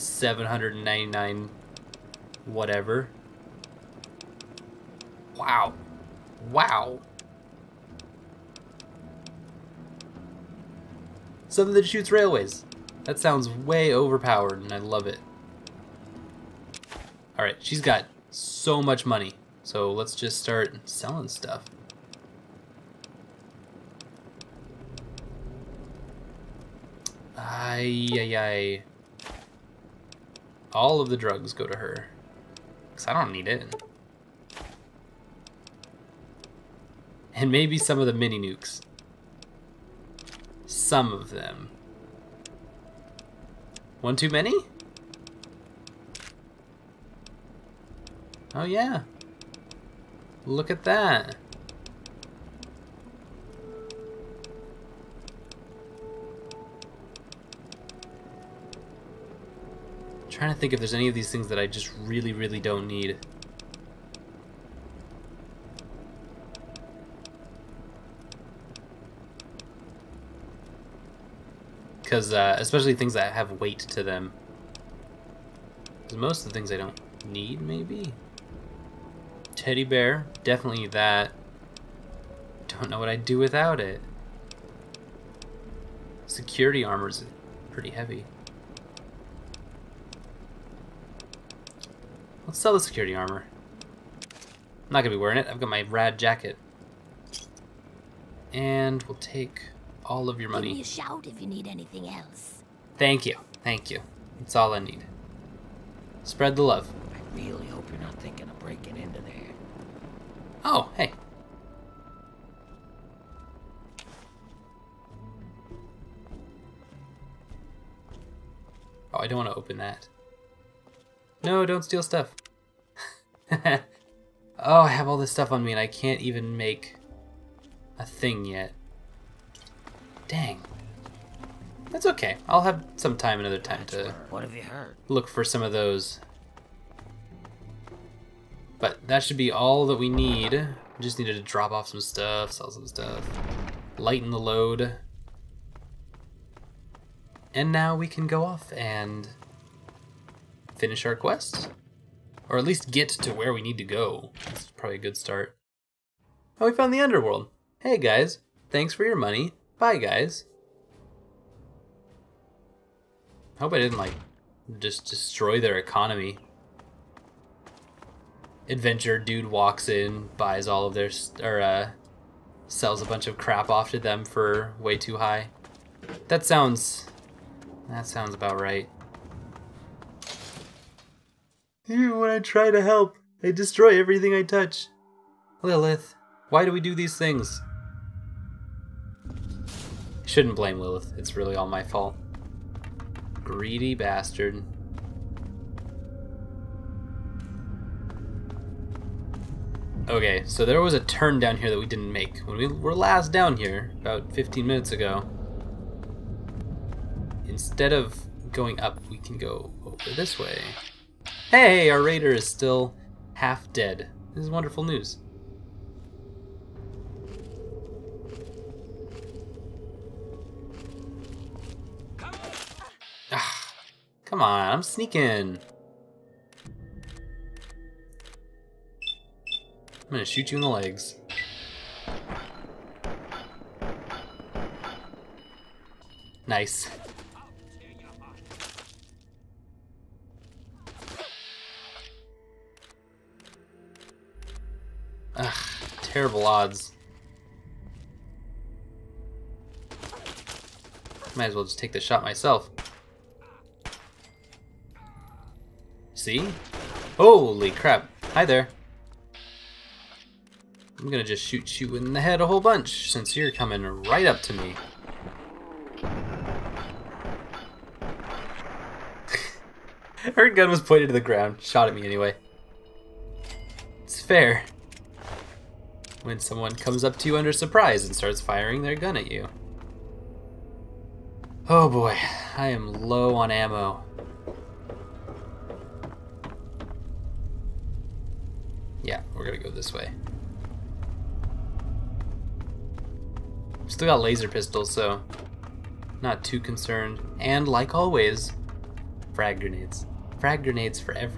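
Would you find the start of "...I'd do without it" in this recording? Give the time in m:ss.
1:23.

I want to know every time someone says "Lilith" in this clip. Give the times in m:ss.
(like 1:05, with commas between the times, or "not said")
3:05, 3:10.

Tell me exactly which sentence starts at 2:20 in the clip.
just needed to drop off some stuff, sell some stuff, lighten the load.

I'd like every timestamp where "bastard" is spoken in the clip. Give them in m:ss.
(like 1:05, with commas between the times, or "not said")
3:13.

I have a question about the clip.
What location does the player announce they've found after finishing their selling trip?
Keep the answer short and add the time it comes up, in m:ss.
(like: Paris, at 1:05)
The underworld, at 2:36.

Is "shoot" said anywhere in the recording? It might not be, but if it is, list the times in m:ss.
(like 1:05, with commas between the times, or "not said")
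0:11, 3:50, 4:21.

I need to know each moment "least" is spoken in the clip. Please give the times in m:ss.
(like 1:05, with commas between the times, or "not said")
2:32.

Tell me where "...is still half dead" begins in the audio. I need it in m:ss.
3:32.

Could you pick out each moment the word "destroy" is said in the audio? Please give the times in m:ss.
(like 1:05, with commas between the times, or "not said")
2:45, 3:03.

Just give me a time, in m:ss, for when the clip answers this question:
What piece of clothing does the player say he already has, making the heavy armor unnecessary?
1:35.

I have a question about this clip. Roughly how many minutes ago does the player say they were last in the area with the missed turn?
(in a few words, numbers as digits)
15 minutes.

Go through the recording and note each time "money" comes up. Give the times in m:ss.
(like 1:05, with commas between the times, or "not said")
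0:19, 1:40, 2:39.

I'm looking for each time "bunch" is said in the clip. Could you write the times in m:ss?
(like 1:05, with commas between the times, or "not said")
2:53, 4:22.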